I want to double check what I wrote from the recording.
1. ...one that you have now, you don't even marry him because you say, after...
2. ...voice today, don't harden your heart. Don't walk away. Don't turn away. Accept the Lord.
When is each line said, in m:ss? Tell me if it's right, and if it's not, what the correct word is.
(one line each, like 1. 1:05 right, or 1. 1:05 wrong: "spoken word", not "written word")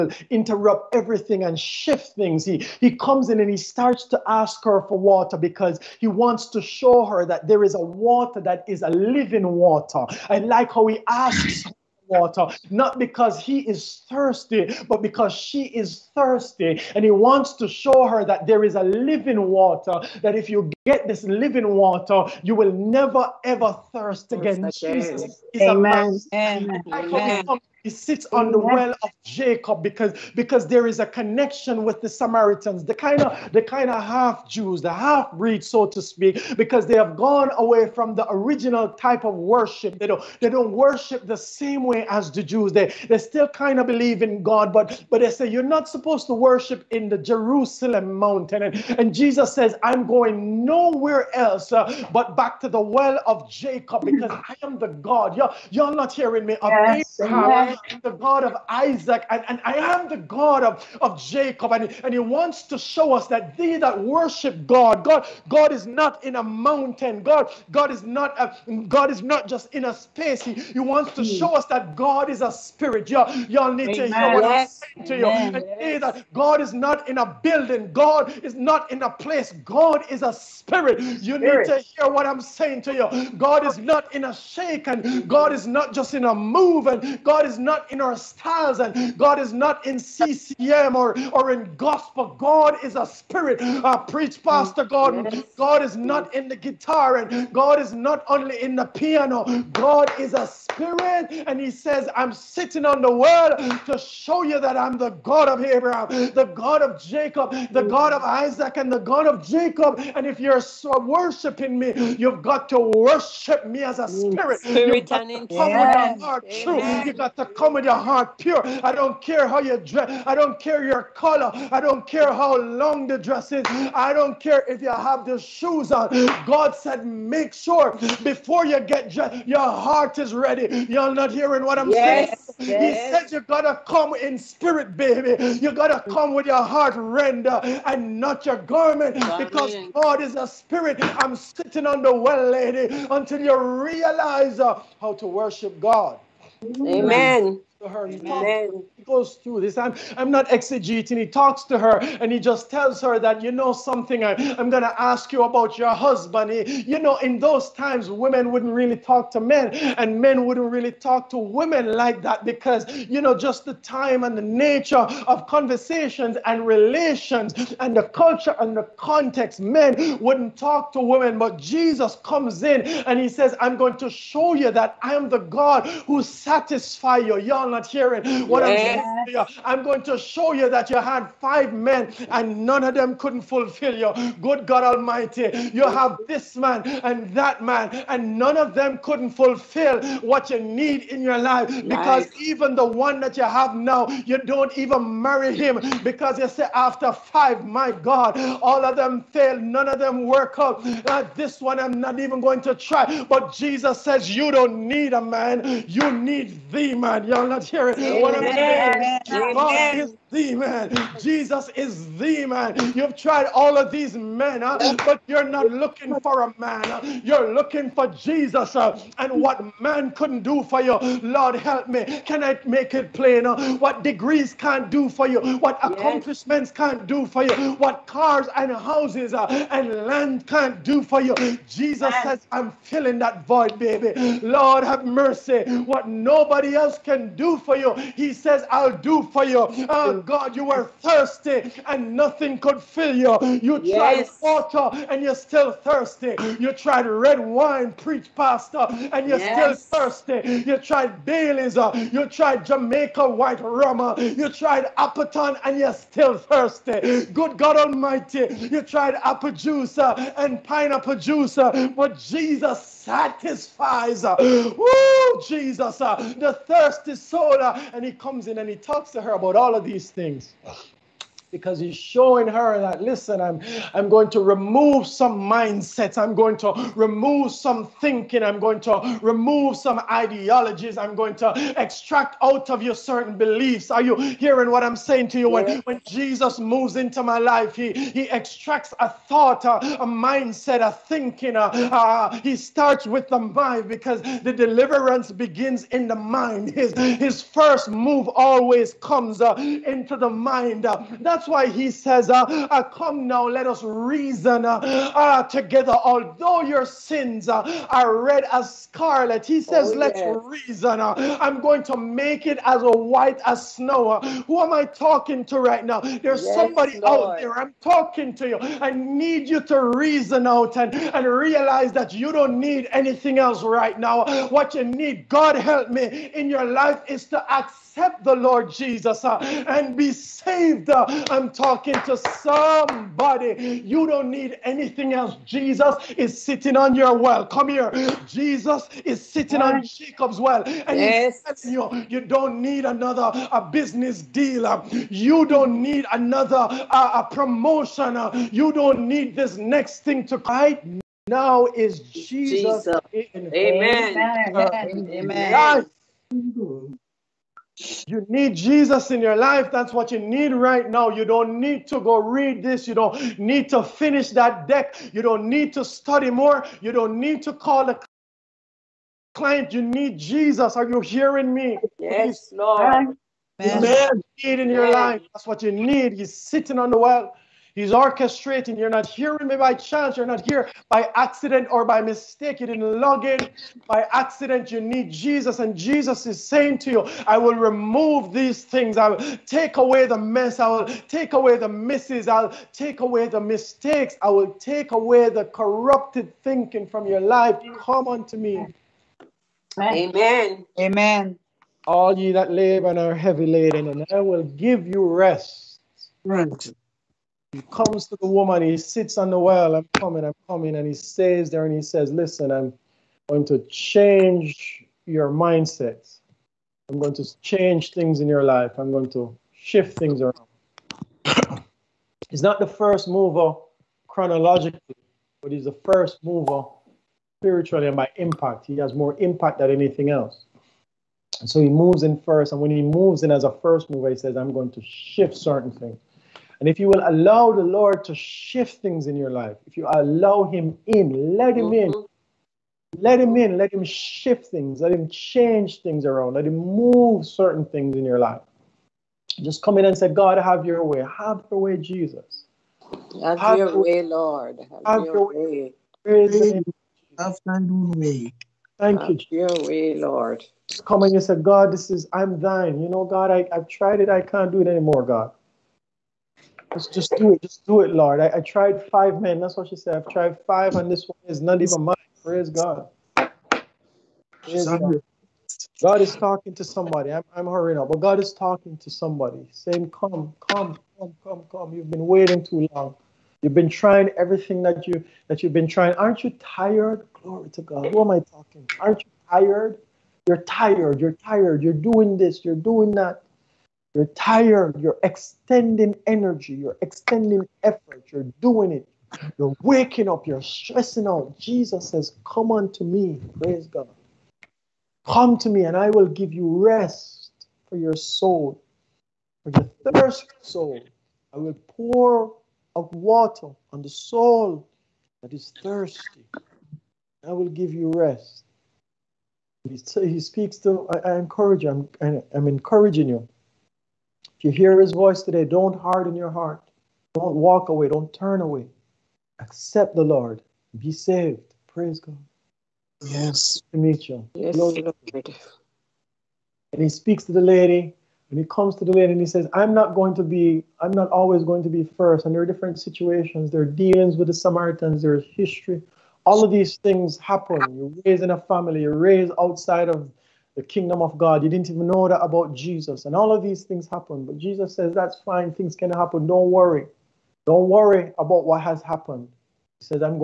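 1. 3:12 right
2. 8:44 right.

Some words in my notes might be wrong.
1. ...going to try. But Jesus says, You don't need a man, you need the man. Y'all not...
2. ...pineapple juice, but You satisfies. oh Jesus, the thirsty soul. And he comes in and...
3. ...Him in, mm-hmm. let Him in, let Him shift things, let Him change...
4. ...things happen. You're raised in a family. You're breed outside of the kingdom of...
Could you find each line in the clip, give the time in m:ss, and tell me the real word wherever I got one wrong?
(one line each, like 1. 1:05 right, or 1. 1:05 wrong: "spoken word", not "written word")
1. 3:22 right
2. 4:20 wrong: "Jesus", not "You"
3. 7:21 right
4. 9:06 wrong: "raised", not "breed".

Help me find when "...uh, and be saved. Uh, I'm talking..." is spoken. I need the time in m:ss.
5:29.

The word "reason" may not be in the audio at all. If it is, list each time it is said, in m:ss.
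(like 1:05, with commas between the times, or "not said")
5:03, 5:10, 5:19.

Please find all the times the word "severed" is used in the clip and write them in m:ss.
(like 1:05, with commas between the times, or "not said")
not said.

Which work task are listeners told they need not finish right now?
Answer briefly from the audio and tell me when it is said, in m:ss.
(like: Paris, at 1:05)
That deck, at 6:04.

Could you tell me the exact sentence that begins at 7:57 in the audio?
I'm, I'm hurrying up, but God is talking to somebody, saying, Come, come, come, come, come.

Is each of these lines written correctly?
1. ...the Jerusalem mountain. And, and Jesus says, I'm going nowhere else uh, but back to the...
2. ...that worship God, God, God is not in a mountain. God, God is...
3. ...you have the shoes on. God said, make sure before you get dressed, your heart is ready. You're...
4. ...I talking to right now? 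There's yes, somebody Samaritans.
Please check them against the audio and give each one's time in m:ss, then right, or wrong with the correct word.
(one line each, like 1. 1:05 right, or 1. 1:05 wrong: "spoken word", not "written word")
1. 0:47 right
2. 1:03 right
3. 2:04 right
4. 5:14 wrong: "Lord", not "Samaritans".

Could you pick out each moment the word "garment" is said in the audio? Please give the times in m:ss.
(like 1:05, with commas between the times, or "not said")
2:18.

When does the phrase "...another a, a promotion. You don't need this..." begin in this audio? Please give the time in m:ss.
5:46.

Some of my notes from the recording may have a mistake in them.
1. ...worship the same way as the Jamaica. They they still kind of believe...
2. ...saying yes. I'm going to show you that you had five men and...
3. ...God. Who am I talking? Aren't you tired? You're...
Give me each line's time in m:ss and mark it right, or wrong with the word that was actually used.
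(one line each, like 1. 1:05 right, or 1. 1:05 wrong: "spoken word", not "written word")
1. 0:40 wrong: "Jews", not "Jamaica"
2. 2:58 right
3. 8:07 right.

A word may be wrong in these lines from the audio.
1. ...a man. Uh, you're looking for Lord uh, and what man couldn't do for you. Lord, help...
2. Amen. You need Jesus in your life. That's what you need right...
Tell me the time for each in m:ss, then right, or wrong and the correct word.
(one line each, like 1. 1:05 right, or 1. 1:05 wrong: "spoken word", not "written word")
1. 3:36 wrong: "Jesus", not "Lord"
2. 5:56 right.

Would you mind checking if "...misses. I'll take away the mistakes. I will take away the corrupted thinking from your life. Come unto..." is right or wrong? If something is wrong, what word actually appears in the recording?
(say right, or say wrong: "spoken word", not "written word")
right.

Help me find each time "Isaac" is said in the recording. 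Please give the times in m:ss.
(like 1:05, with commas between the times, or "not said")
0:58, 1:48.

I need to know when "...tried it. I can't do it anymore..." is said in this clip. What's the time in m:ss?
7:43.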